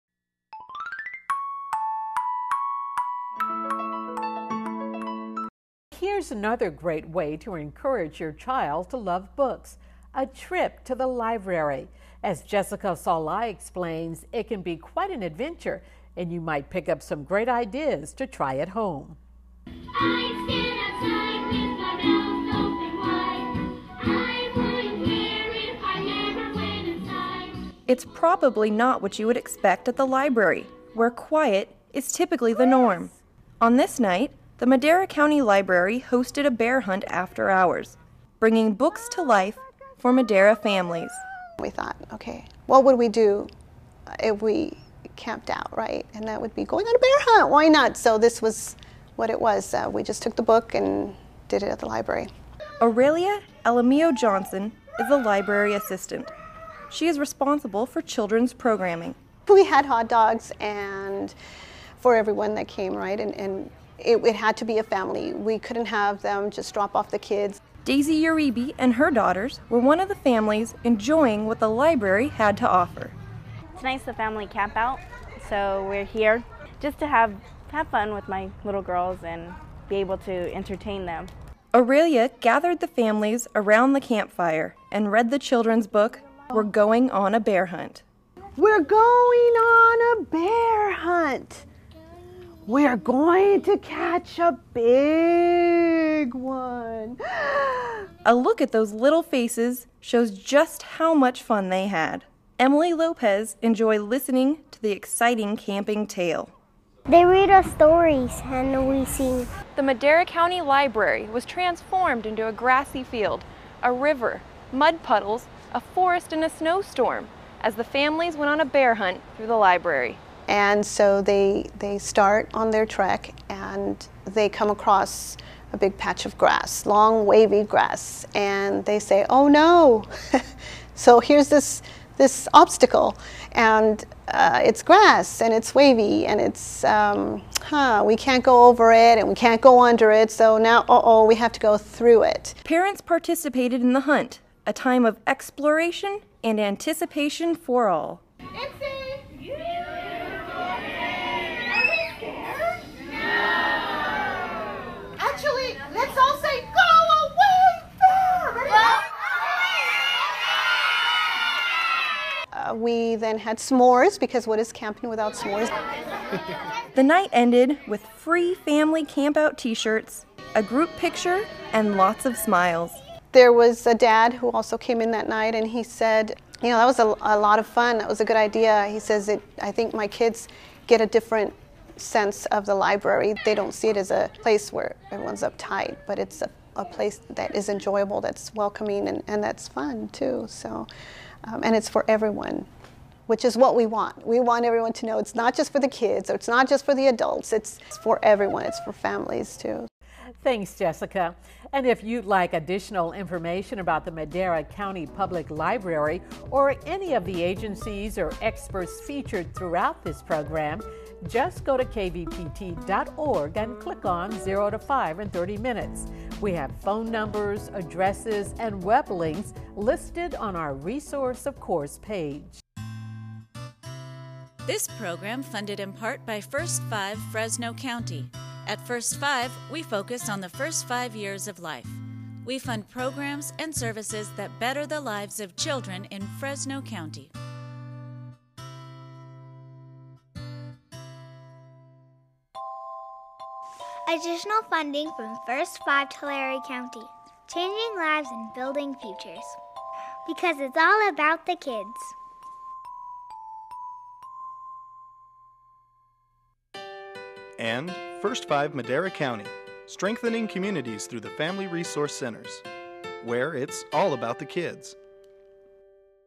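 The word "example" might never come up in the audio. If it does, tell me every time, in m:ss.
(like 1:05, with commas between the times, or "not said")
not said.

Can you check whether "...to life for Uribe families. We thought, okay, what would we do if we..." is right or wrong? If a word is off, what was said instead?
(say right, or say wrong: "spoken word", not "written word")
wrong: "Madera", not "Uribe".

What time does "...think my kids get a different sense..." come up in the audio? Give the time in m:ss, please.
2:59.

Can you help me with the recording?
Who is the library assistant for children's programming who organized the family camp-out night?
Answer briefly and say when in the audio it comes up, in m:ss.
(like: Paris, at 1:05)
Oralia Alamillo Johnson, at 0:52.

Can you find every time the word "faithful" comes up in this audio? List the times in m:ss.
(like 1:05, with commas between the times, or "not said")
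not said.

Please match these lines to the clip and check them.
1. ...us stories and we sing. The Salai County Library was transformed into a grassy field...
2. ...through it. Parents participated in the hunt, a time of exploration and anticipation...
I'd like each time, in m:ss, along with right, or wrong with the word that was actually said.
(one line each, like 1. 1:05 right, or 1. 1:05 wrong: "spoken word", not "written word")
1. 1:47 wrong: "Madera", not "Salai"
2. 2:21 right.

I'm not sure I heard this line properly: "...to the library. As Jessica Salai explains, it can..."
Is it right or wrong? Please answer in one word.
right.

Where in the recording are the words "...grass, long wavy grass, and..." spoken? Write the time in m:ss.
2:06.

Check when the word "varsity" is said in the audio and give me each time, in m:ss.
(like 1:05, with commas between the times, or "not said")
not said.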